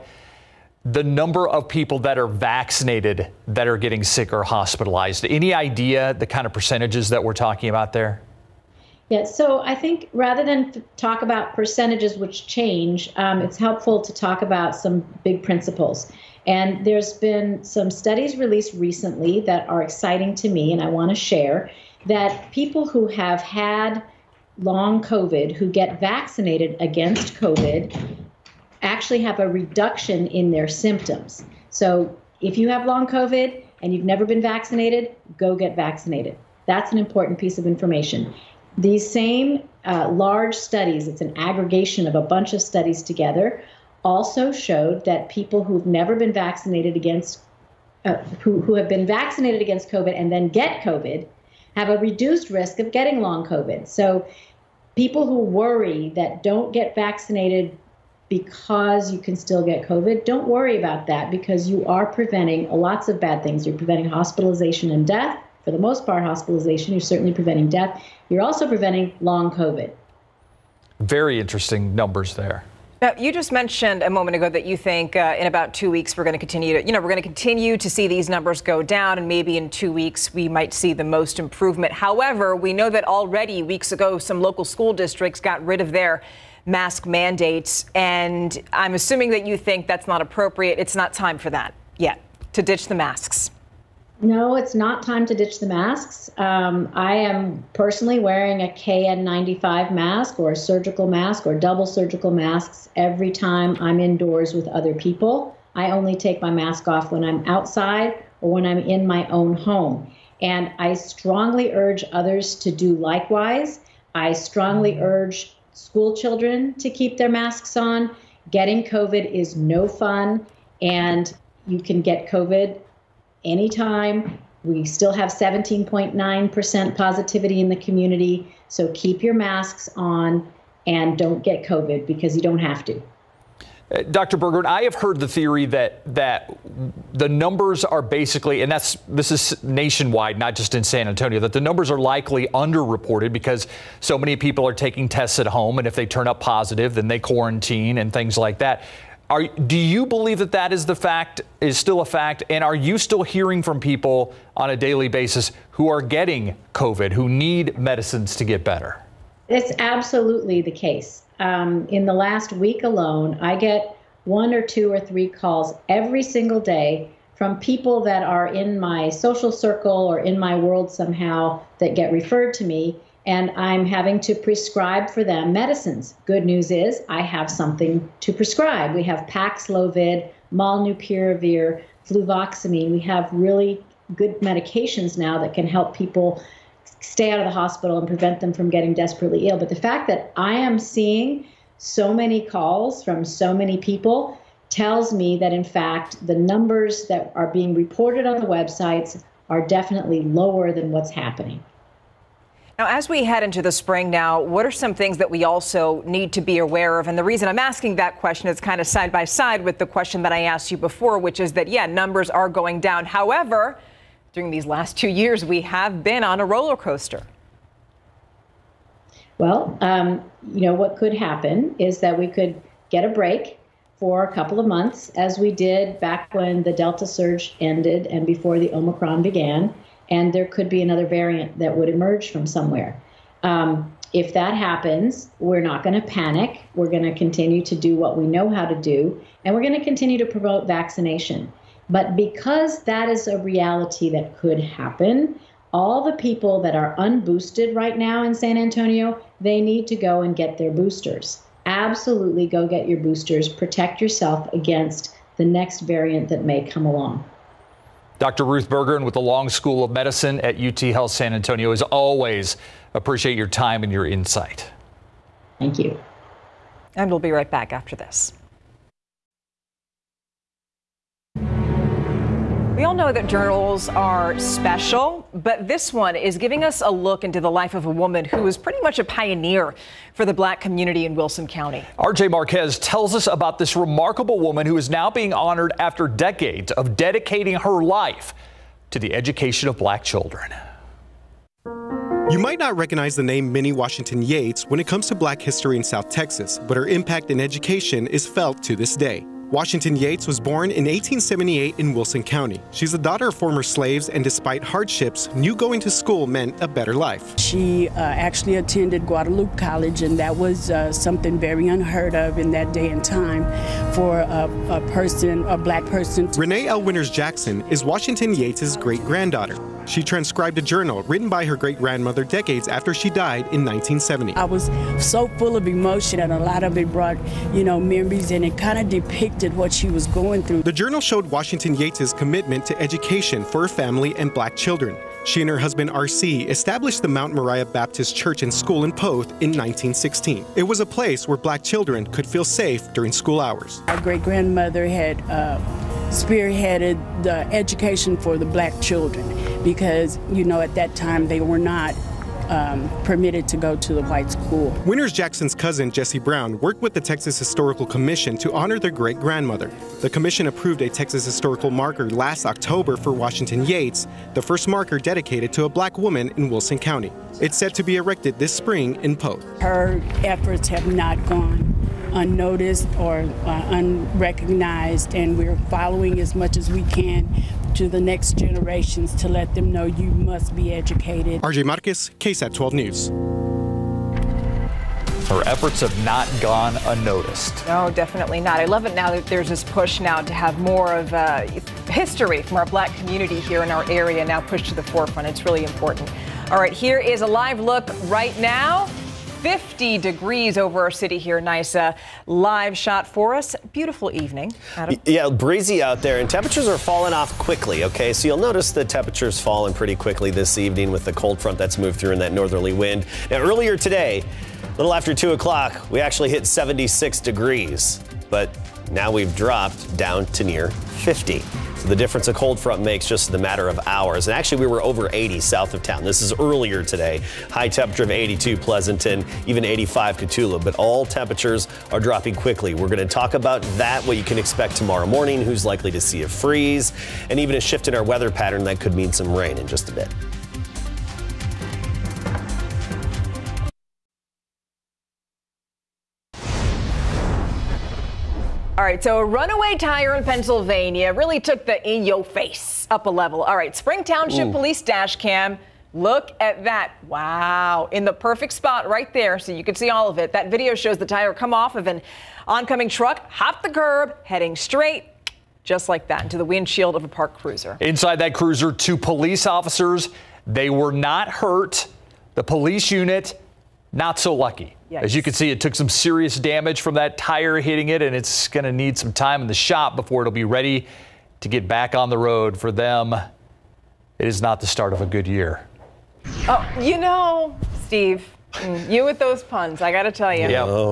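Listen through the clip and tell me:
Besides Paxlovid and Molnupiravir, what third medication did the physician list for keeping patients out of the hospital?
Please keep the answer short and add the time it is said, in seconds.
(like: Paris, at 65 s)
Fluvoxamine, at 182 s.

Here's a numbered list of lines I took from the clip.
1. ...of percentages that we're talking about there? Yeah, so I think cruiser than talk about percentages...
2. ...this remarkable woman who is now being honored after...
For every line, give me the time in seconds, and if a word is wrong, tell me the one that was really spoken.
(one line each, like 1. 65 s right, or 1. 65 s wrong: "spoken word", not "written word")
1. 6 s wrong: "rather", not "cruiser"
2. 283 s right.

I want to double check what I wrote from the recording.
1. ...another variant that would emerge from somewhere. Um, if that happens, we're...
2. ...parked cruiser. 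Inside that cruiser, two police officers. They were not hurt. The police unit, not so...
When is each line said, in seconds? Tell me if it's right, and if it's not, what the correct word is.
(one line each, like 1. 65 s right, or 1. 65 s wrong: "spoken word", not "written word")
1. 230 s right
2. 467 s right.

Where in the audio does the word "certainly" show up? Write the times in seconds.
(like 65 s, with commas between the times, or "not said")
66 s.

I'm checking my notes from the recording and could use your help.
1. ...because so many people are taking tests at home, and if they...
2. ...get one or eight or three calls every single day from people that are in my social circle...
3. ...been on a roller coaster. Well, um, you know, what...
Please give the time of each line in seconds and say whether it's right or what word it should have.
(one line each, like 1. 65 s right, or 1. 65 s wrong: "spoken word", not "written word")
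1. 143 s right
2. 163 s wrong: "two", not "eight"
3. 216 s right.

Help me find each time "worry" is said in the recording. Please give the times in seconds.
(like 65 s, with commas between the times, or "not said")
55 s, 60 s.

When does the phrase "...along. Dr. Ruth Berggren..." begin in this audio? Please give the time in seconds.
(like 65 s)
256 s.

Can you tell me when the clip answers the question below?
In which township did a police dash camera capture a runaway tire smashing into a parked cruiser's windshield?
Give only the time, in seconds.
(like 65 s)
453 s.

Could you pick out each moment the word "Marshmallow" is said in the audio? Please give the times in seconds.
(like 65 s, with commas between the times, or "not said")
not said.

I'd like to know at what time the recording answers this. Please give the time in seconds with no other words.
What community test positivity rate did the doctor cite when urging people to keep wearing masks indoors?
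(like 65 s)
125 s.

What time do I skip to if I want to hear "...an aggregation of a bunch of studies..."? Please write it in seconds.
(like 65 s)
41 s.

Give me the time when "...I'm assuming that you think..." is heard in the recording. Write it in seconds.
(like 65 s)
88 s.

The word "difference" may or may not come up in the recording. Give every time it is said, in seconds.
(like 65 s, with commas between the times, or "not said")
421 s.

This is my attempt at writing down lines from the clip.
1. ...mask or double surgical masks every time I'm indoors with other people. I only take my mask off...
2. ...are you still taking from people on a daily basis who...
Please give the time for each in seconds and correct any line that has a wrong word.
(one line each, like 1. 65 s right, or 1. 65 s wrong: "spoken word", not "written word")
1. 101 s right
2. 152 s wrong: "hearing", not "taking".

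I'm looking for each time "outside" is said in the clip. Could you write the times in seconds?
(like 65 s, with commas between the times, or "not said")
107 s.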